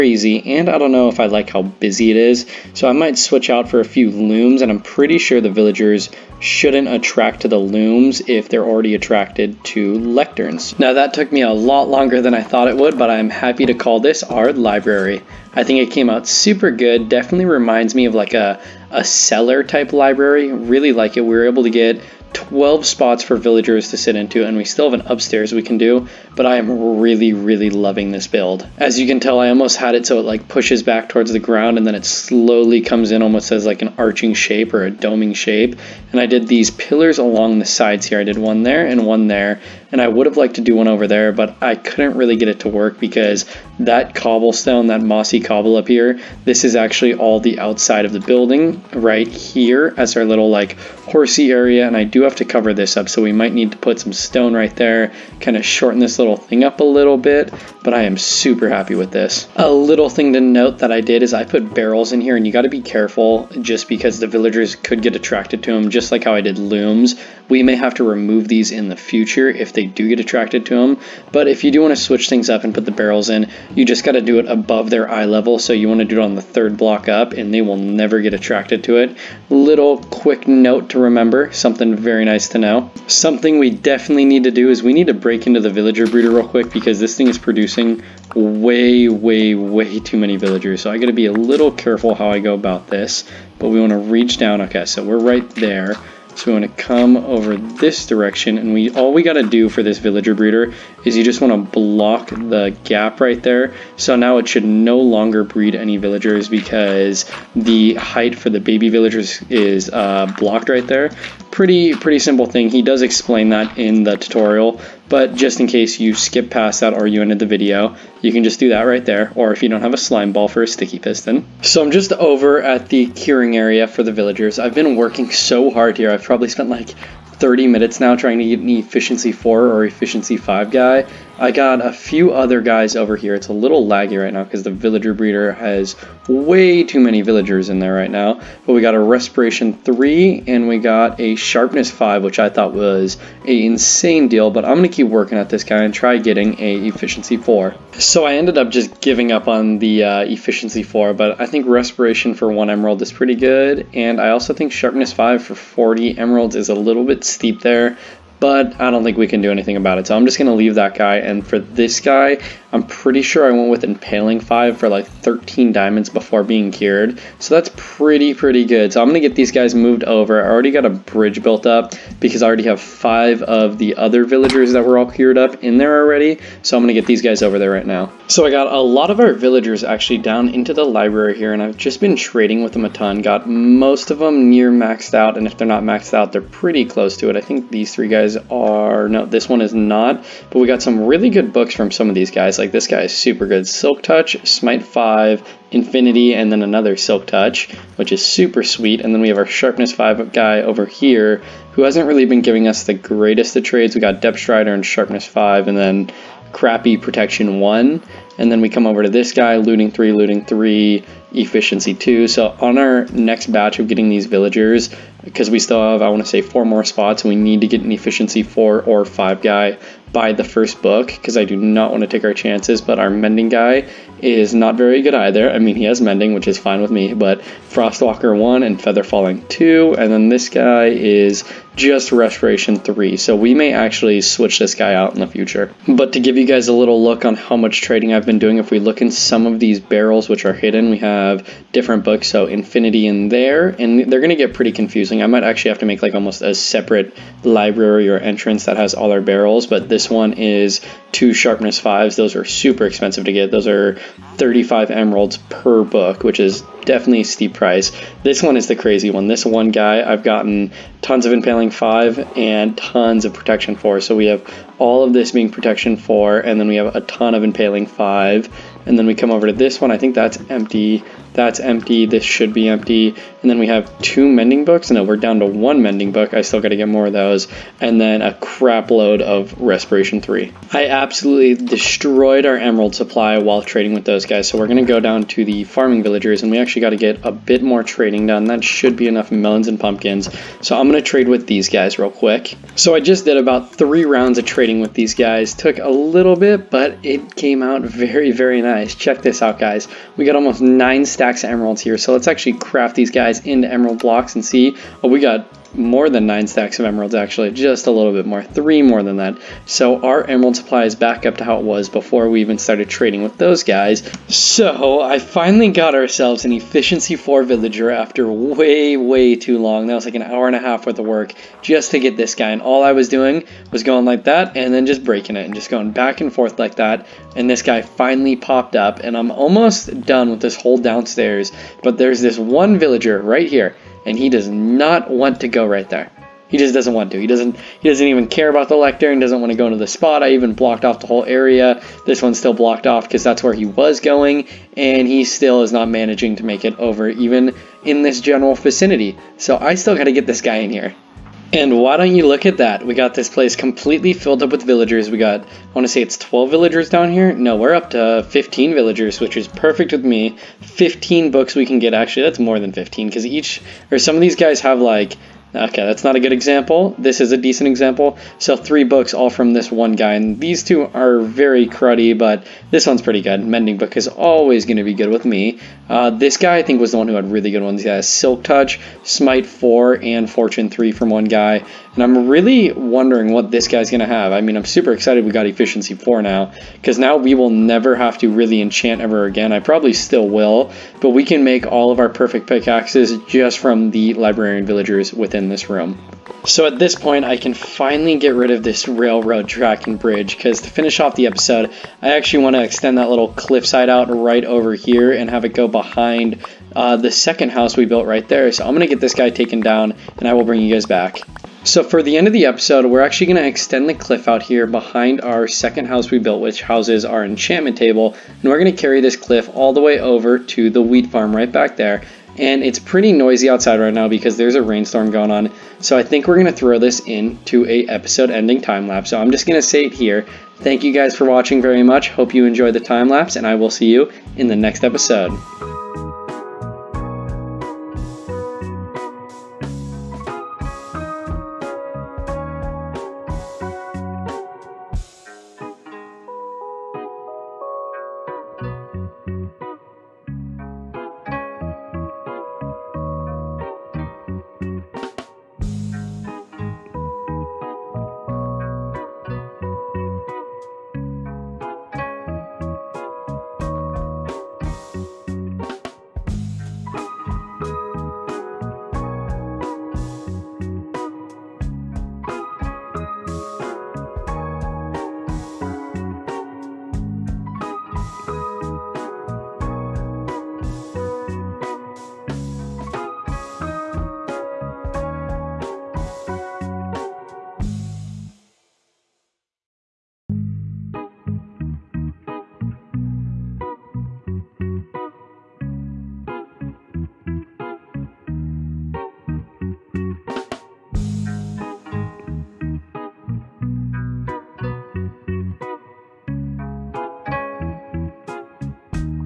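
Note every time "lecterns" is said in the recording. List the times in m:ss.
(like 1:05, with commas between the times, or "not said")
0:09, 5:38.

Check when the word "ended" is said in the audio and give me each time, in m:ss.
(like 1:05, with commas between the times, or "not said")
1:57, 2:28.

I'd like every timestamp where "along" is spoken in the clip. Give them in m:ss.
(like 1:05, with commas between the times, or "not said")
0:37.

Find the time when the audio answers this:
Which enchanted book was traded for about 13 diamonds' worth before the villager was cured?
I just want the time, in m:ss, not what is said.
2:43.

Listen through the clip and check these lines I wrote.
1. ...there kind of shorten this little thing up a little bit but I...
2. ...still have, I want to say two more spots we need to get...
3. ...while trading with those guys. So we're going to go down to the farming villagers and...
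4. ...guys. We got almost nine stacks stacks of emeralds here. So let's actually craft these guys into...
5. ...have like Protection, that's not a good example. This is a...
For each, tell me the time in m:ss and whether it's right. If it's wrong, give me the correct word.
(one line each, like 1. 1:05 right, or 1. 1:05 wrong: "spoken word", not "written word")
1. 0:54 right
2. 3:35 wrong: "four", not "two"
3. 4:43 right
4. 4:59 right
5. 6:04 wrong: "Okay", not "Protection".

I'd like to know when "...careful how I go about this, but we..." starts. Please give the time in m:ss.
1:31.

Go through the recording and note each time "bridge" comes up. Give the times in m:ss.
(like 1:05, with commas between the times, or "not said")
2:50, 6:39.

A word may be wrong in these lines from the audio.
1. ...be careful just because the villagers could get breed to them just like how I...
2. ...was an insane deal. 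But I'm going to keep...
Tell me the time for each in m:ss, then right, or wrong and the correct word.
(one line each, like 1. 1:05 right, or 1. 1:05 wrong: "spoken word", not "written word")
1. 1:02 wrong: "attracted", not "breed"
2. 2:22 right.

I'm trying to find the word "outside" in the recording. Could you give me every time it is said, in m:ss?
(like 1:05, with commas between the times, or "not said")
0:47, 7:03.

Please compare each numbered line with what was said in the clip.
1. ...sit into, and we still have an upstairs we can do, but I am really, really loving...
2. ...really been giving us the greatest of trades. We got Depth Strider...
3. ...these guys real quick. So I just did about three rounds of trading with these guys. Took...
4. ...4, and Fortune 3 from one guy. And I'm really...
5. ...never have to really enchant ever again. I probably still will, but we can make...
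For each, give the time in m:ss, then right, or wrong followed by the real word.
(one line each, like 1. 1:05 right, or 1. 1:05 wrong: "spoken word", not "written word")
1. 0:23 right
2. 3:22 right
3. 4:51 right
4. 6:19 right
5. 6:27 right.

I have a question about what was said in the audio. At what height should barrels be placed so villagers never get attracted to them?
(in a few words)
third block up.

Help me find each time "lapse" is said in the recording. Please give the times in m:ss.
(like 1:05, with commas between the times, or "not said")
7:08, 7:13.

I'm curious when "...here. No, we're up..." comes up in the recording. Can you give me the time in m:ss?
5:57.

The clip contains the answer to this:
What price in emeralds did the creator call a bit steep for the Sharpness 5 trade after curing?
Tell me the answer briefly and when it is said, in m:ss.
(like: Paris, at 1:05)
40 emeralds, at 2:35.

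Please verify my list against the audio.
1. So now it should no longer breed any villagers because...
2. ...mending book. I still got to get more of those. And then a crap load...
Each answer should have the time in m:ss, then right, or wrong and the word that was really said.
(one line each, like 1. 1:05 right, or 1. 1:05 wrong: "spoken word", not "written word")
1. 1:43 right
2. 4:35 right.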